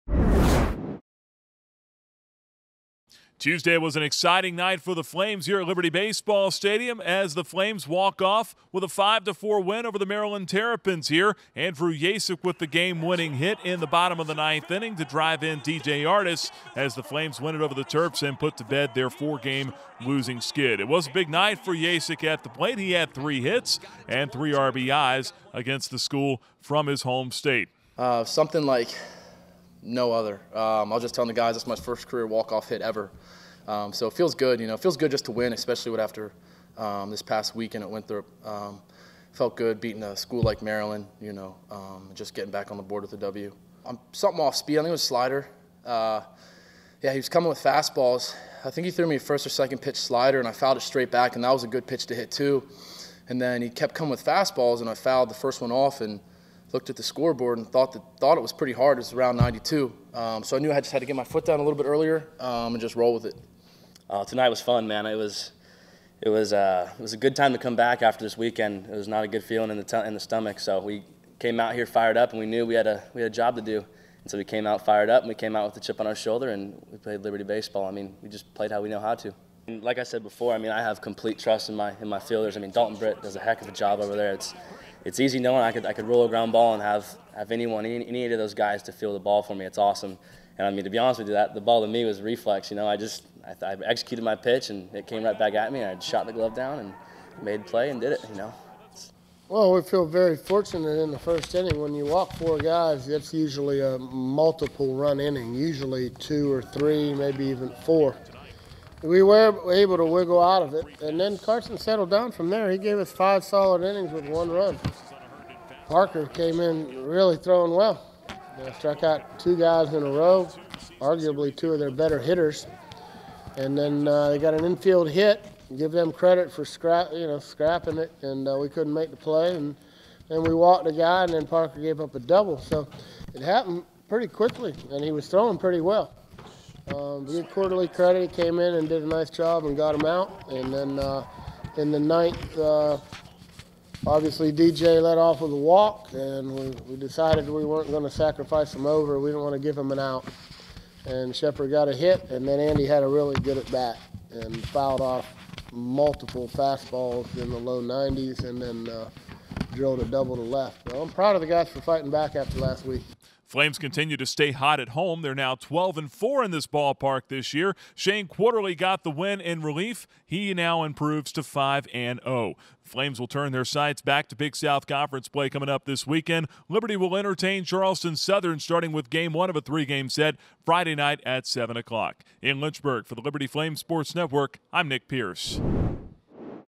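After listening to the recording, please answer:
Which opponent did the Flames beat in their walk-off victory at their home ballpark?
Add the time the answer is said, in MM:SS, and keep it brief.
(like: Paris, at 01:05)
Maryland Terrapins, at 00:10.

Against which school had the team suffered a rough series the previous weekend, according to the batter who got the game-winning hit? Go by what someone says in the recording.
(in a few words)
Winthrop.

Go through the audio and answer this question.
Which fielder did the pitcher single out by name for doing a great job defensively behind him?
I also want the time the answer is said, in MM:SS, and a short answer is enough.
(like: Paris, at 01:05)
Dalton Britt, at 01:22.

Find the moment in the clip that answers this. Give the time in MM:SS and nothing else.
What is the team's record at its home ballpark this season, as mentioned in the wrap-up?
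02:45.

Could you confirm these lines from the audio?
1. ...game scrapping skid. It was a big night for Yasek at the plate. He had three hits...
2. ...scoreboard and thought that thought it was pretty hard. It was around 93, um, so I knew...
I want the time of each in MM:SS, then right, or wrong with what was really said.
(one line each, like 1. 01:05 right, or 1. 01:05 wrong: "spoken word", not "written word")
1. 00:19 wrong: "losing", not "scrapping"
2. 00:57 wrong: "92", not "93".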